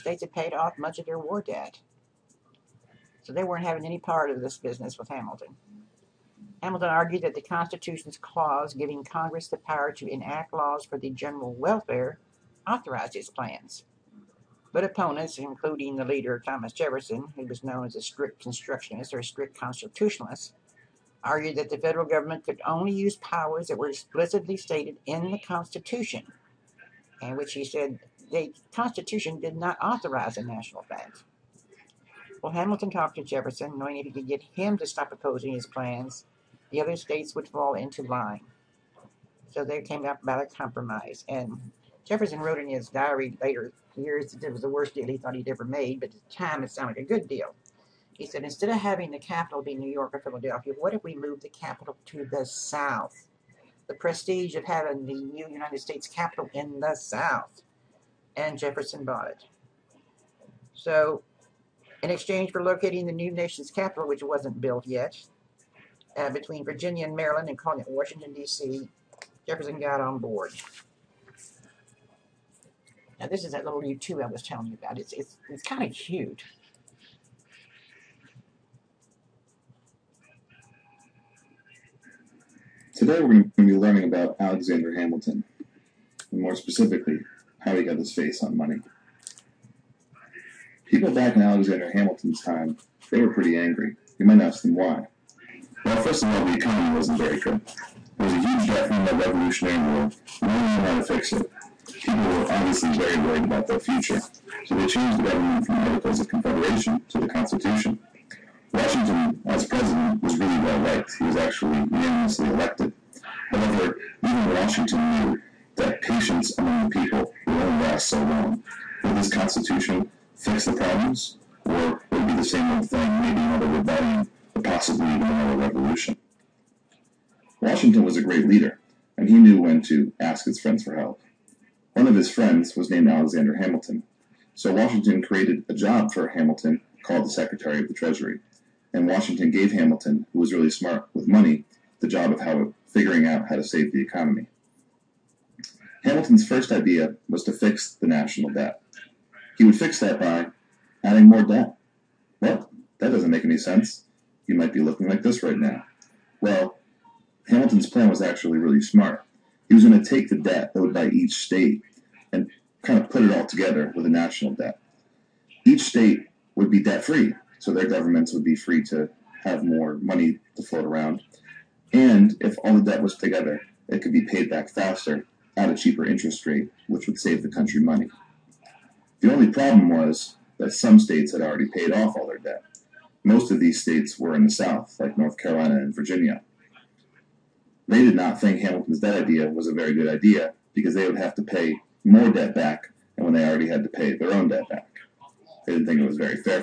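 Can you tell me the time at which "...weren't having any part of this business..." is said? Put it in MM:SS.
00:03.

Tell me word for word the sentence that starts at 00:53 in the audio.
The prestige of having the new United States capital in the South.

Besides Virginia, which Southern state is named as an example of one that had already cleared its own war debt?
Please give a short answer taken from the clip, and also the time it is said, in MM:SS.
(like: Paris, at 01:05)
North Carolina, at 03:05.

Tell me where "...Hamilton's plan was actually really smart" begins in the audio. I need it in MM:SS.
02:37.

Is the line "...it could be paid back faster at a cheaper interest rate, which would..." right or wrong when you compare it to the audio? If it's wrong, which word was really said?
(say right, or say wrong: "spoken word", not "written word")
right.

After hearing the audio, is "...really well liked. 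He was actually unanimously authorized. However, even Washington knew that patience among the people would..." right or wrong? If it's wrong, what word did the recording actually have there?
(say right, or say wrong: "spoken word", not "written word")
wrong: "elected", not "authorized".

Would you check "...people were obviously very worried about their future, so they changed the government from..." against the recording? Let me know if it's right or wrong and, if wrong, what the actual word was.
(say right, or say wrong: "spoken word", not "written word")
right.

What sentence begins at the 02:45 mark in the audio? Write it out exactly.
Each state would be debt free, so their governments would be free to have more money to float around.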